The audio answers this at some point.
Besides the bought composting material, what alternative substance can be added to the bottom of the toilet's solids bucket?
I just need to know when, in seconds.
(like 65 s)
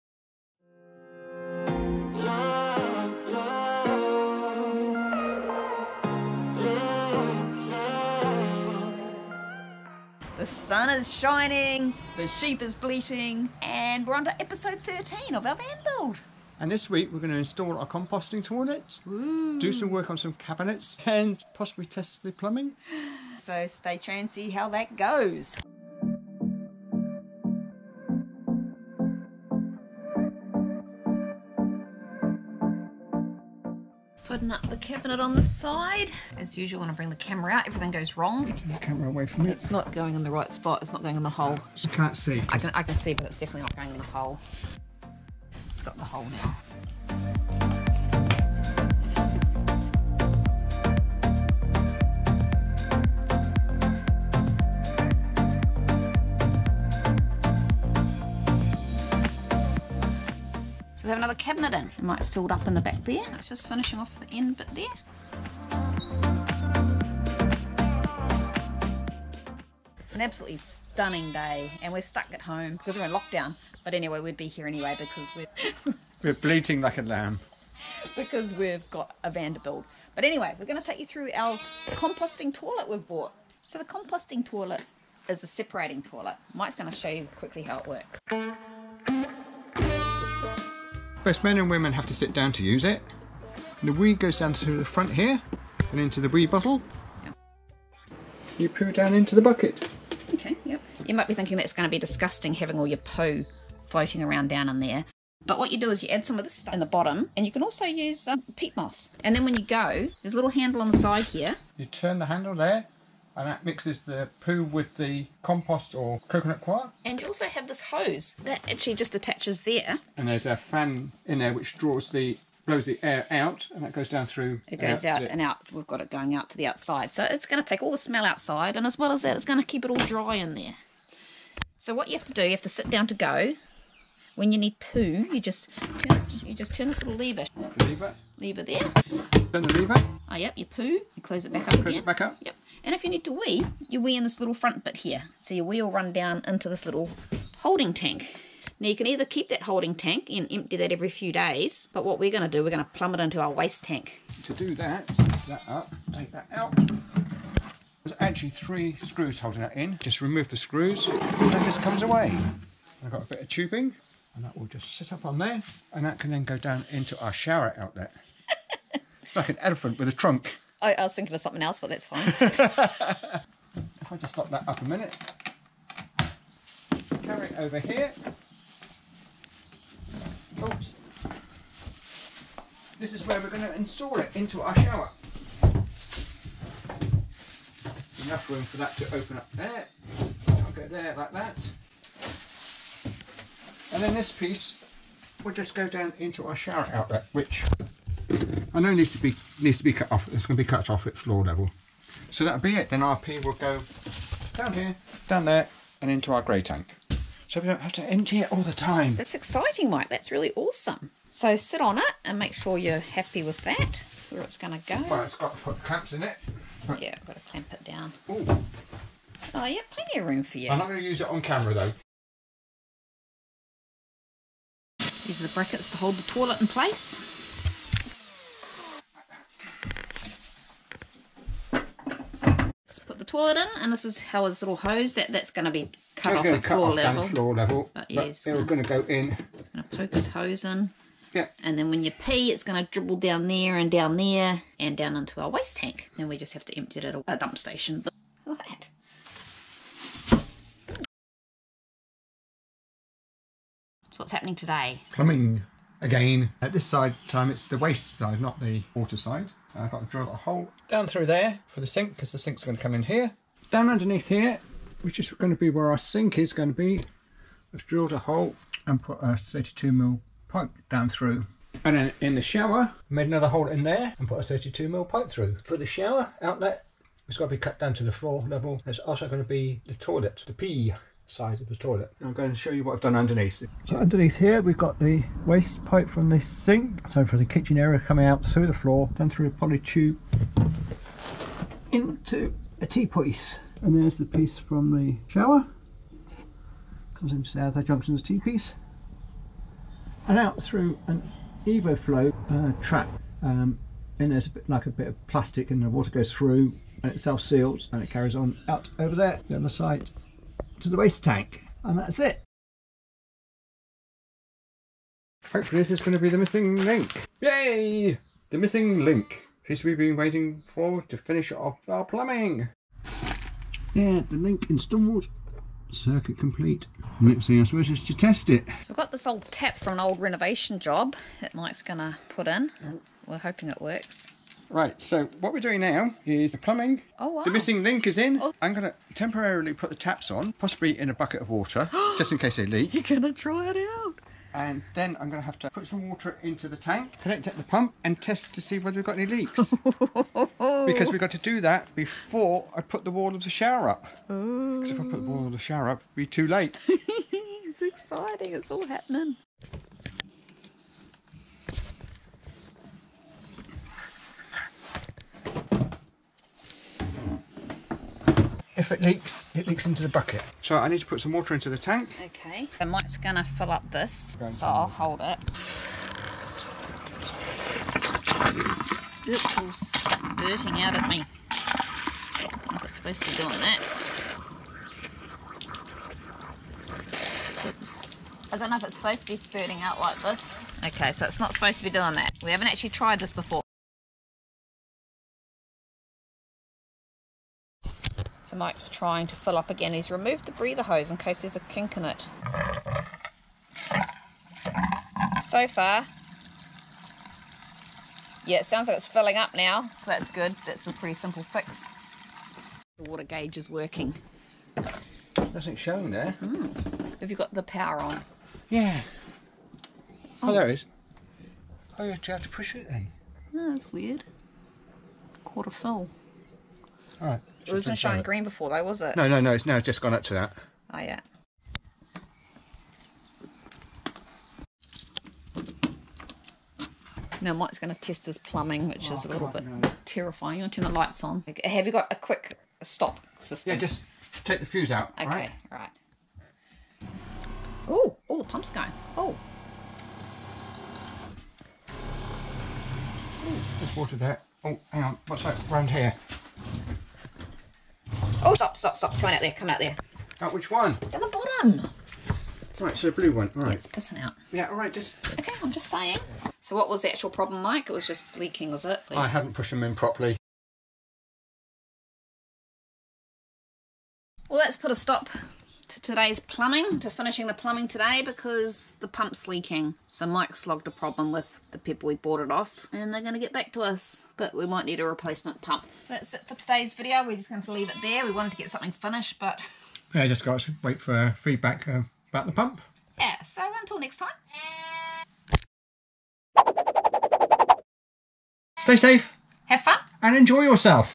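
108 s.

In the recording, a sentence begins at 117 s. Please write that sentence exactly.
And you also have this hose that actually just attaches there.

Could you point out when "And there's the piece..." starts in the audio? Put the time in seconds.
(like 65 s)
293 s.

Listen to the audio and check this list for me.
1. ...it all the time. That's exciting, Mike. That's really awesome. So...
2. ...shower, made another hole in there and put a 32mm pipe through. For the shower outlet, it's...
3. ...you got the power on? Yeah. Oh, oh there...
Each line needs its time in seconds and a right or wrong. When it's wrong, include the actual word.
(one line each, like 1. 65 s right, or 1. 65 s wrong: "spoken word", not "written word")
1. 208 s right
2. 272 s right
3. 417 s right.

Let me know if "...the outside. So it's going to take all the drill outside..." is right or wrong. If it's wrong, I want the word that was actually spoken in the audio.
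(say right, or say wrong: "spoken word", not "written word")
wrong: "smell", not "drill".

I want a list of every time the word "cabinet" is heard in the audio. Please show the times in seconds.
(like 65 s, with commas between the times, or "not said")
20 s, 34 s, 61 s.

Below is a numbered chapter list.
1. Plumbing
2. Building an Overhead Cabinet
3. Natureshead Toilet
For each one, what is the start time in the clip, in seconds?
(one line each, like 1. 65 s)
1. 250 s
2. 25 s
3. 80 s.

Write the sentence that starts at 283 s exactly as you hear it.
So underneath here we've got the waste pipe from the sink.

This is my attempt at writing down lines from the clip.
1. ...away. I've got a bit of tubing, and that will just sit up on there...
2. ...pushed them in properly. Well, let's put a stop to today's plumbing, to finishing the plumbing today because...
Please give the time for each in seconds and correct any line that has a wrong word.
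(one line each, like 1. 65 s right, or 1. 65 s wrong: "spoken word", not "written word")
1. 162 s right
2. 469 s right.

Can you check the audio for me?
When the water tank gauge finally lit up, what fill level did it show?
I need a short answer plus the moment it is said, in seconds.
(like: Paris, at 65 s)
Quarter full, at 425 s.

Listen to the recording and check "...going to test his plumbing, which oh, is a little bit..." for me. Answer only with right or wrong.
right.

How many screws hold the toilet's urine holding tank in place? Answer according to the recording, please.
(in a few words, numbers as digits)
3.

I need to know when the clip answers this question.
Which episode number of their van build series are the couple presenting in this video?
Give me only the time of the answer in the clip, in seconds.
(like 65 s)
14 s.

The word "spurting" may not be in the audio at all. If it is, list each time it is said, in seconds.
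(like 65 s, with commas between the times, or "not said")
379 s, 389 s.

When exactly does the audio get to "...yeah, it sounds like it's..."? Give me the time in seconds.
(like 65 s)
408 s.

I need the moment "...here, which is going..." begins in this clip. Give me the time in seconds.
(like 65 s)
264 s.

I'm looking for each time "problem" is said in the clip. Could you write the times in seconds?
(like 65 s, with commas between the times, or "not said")
467 s, 480 s.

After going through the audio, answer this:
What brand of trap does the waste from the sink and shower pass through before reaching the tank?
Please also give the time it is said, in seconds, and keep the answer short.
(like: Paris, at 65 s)
EvoFlow, at 301 s.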